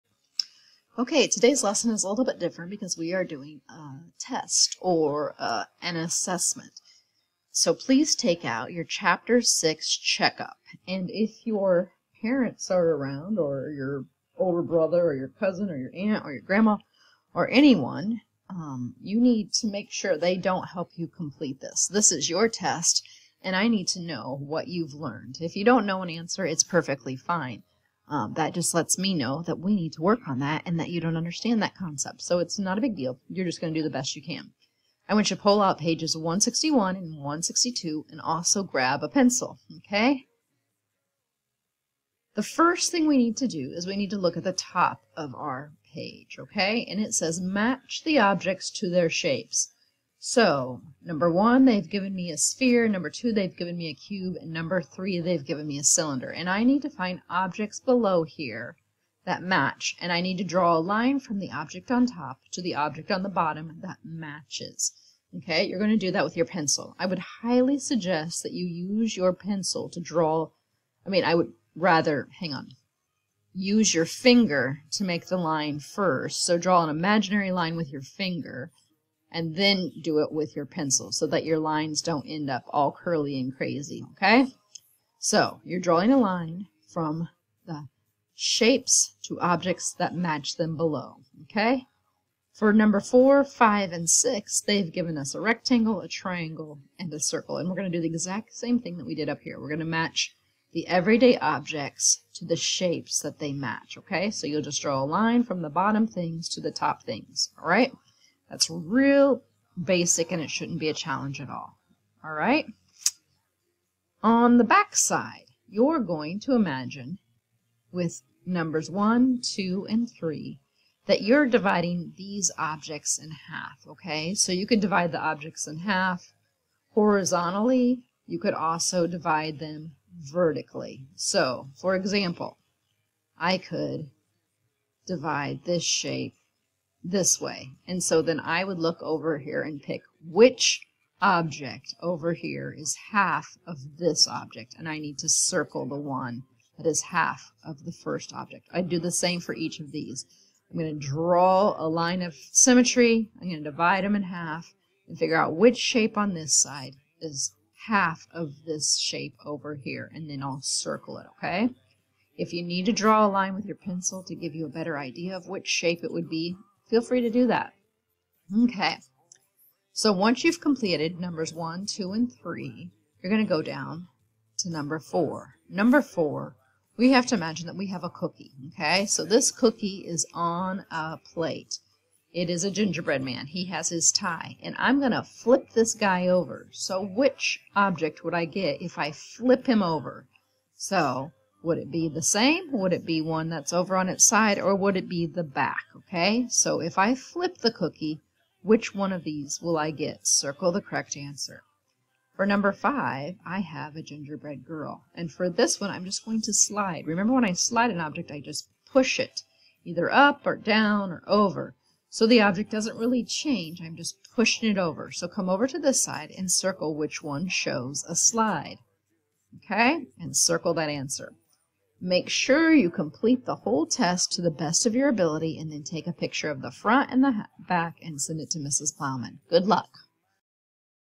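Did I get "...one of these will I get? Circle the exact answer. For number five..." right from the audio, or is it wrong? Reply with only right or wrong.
wrong.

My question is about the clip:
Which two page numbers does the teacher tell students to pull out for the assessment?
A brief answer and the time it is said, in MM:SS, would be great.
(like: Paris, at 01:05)
161 and 162, at 00:36.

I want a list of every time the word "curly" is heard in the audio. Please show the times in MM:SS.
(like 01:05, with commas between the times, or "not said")
01:22.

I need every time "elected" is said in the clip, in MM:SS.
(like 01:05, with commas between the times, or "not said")
not said.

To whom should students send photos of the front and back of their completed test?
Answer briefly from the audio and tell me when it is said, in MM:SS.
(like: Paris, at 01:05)
Mrs. Plowman, at 03:48.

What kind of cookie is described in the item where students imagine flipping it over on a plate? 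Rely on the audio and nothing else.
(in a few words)
gingerbread man.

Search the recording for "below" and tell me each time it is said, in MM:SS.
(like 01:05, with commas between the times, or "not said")
00:57, 01:30.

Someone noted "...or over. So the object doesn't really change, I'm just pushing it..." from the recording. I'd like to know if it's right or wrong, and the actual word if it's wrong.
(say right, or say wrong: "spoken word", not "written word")
right.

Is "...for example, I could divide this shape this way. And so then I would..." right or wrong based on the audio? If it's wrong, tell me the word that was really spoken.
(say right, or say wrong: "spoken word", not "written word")
right.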